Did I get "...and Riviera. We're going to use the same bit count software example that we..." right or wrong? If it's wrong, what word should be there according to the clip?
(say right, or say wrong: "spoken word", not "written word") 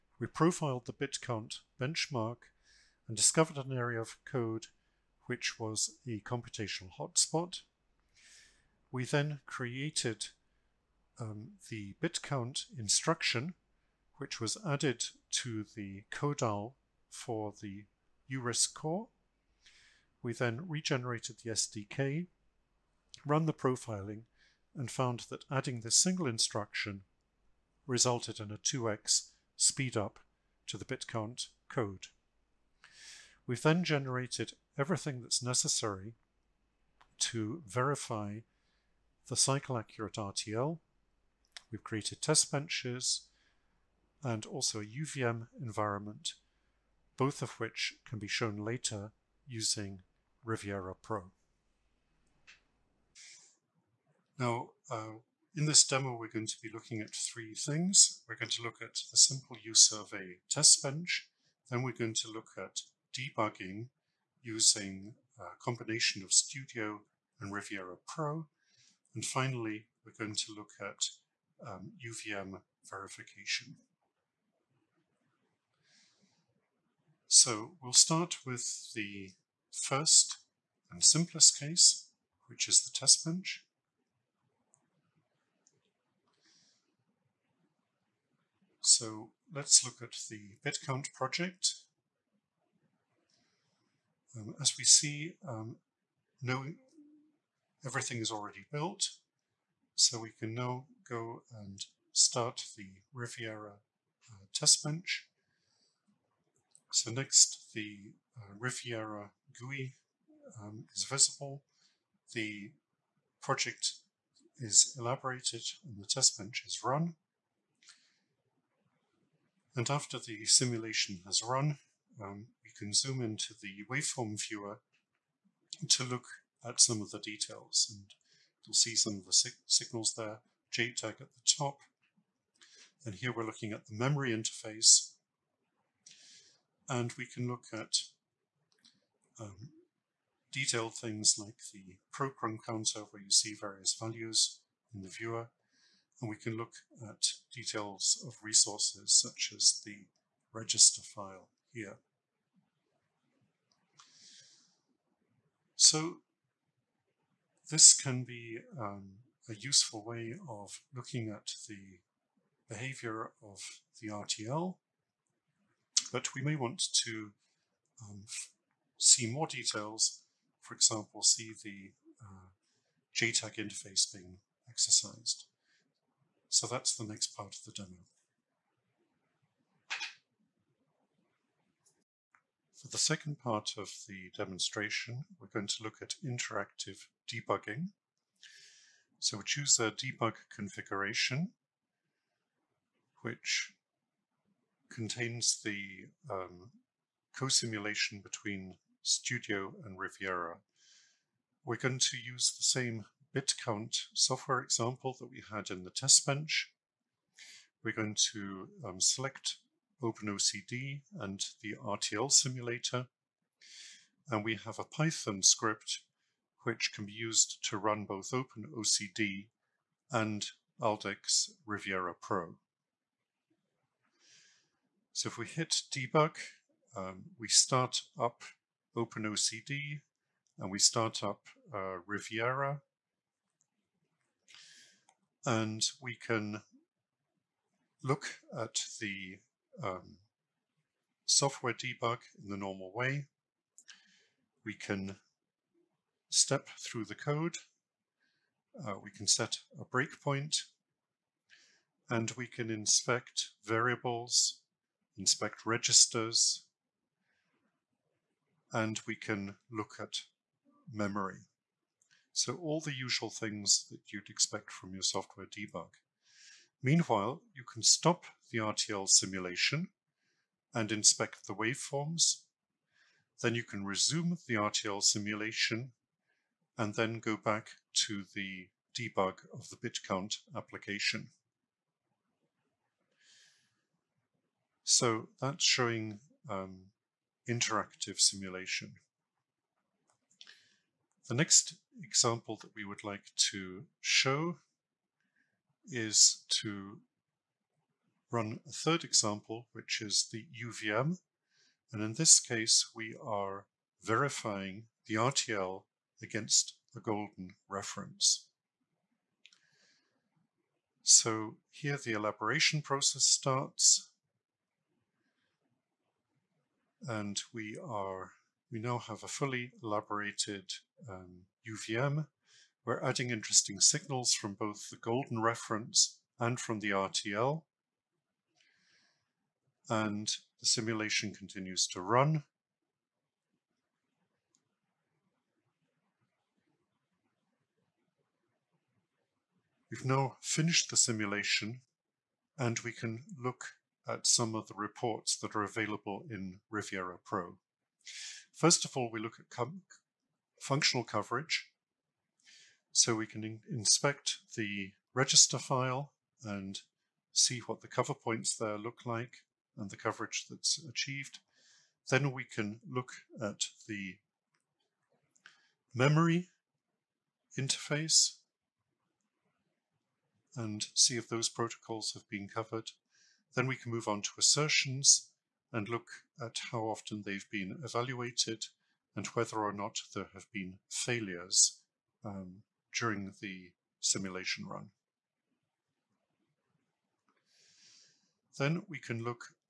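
right.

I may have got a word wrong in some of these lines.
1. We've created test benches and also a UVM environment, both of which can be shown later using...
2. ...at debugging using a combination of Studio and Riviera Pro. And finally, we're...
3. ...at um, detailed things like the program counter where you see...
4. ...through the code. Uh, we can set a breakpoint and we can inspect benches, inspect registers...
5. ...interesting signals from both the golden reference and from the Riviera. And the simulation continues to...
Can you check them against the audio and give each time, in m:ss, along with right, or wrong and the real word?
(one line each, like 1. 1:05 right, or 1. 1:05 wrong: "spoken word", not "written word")
1. 0:41 right
2. 1:02 right
3. 2:17 right
4. 4:06 wrong: "variables", not "benches"
5. 5:23 wrong: "RTL", not "Riviera".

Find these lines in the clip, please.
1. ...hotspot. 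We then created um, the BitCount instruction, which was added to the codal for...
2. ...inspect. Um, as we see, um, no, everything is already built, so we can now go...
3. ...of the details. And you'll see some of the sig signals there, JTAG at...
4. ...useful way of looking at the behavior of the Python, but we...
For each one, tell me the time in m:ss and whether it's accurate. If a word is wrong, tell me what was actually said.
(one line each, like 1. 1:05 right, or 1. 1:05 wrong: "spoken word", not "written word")
1. 0:06 right
2. 1:31 wrong: "project", not "inspect"
3. 2:06 right
4. 2:39 wrong: "RTL", not "Python".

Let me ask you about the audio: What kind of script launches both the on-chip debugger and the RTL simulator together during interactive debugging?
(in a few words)
Python script.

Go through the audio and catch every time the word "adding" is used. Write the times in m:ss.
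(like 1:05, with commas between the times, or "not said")
0:25, 5:23.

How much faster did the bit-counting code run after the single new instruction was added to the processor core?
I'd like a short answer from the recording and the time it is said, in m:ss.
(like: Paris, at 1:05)
2x, at 0:28.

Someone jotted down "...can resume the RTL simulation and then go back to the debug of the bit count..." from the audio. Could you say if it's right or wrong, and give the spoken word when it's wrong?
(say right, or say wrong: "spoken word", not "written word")
right.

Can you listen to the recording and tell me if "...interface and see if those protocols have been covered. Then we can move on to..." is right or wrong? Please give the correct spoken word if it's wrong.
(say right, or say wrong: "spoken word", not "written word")
right.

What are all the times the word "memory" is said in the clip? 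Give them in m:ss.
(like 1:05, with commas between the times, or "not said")
2:13, 4:20, 6:05.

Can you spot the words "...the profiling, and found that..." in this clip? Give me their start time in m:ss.
0:23.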